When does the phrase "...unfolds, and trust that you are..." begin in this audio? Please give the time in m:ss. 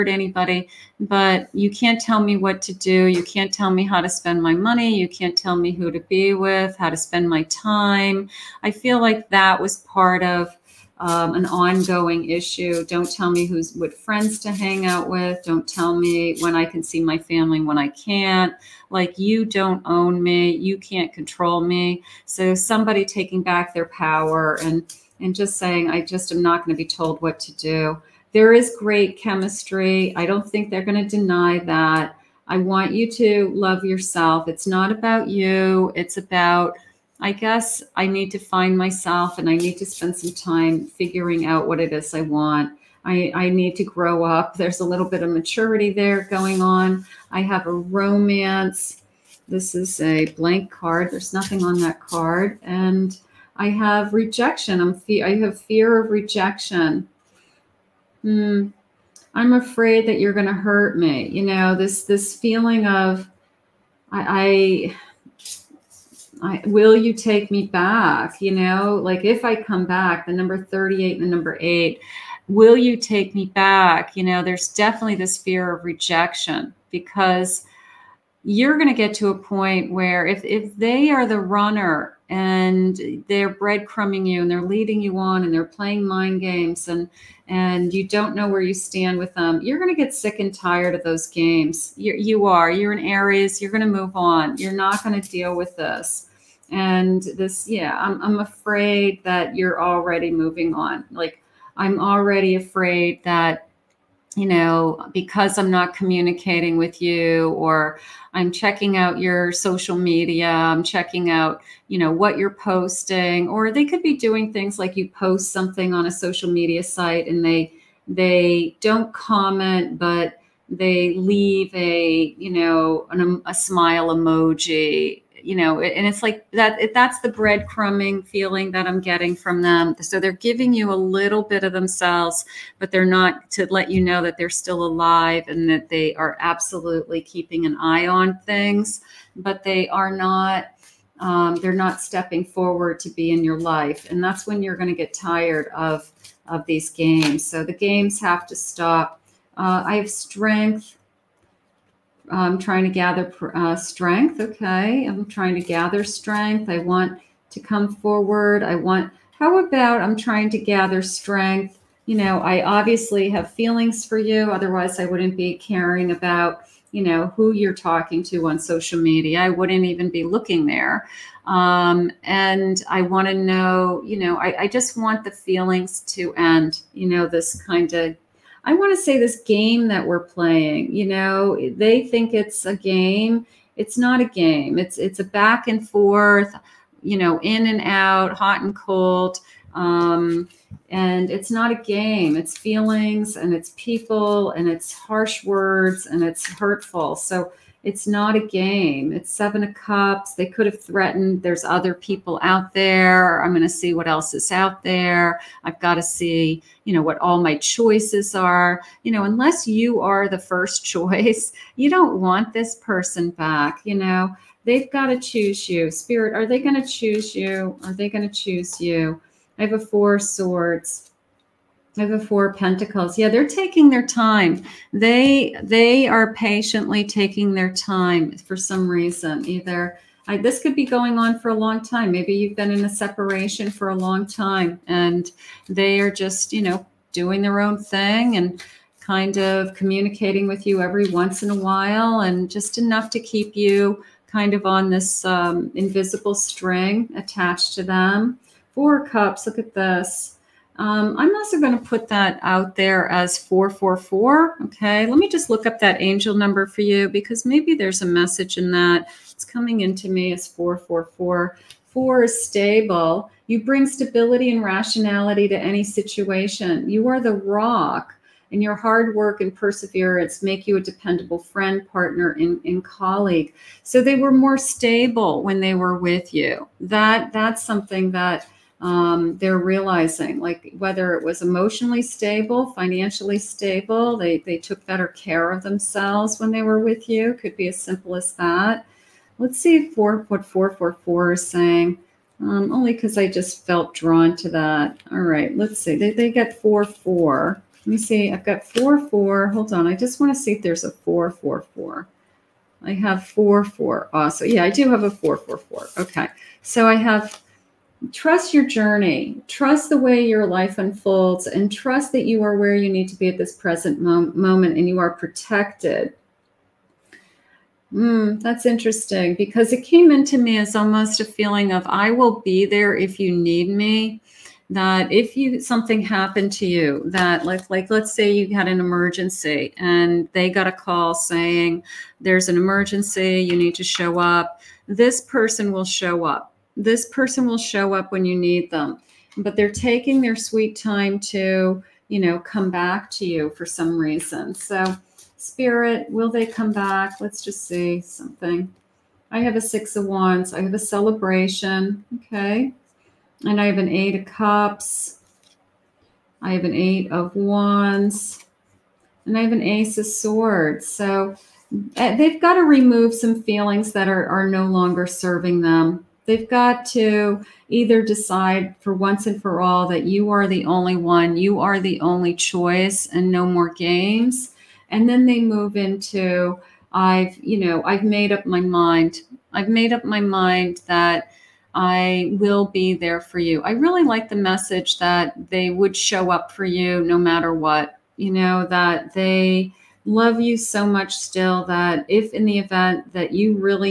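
5:10.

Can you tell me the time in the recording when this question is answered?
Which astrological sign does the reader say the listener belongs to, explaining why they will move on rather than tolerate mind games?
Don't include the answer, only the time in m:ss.
1:33.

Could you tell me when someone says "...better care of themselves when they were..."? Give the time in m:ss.
4:44.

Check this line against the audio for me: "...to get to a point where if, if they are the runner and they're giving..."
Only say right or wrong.
wrong.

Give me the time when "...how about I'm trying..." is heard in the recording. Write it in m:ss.
2:39.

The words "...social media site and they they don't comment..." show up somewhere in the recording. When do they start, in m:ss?
1:56.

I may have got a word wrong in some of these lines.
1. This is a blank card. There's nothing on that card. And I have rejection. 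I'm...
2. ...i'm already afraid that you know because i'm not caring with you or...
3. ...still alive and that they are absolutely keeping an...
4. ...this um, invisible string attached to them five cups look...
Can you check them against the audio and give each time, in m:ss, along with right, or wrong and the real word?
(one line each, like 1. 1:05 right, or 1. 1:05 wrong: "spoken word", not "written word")
1. 0:49 right
2. 1:41 wrong: "communicating", not "caring"
3. 2:14 right
4. 4:04 wrong: "four", not "five".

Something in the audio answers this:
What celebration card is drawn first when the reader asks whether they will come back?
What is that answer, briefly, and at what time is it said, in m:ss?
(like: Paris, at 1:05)
Six of Wands, at 5:49.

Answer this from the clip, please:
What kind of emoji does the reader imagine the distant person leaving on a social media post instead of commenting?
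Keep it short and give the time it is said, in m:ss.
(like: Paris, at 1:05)
smile emoji, at 2:03.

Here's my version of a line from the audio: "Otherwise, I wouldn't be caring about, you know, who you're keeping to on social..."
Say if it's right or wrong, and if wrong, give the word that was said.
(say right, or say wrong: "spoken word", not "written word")
wrong: "talking", not "keeping".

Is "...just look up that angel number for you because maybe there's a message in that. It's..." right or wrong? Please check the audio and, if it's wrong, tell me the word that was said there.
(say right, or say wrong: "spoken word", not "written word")
right.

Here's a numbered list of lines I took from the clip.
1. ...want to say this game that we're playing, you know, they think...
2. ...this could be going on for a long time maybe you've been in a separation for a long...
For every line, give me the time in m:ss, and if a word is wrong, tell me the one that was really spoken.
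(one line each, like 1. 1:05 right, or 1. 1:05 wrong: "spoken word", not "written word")
1. 2:58 right
2. 3:50 right.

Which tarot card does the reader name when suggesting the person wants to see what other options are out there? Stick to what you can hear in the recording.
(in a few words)
Seven of Cups.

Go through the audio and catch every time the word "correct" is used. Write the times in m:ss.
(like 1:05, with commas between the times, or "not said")
not said.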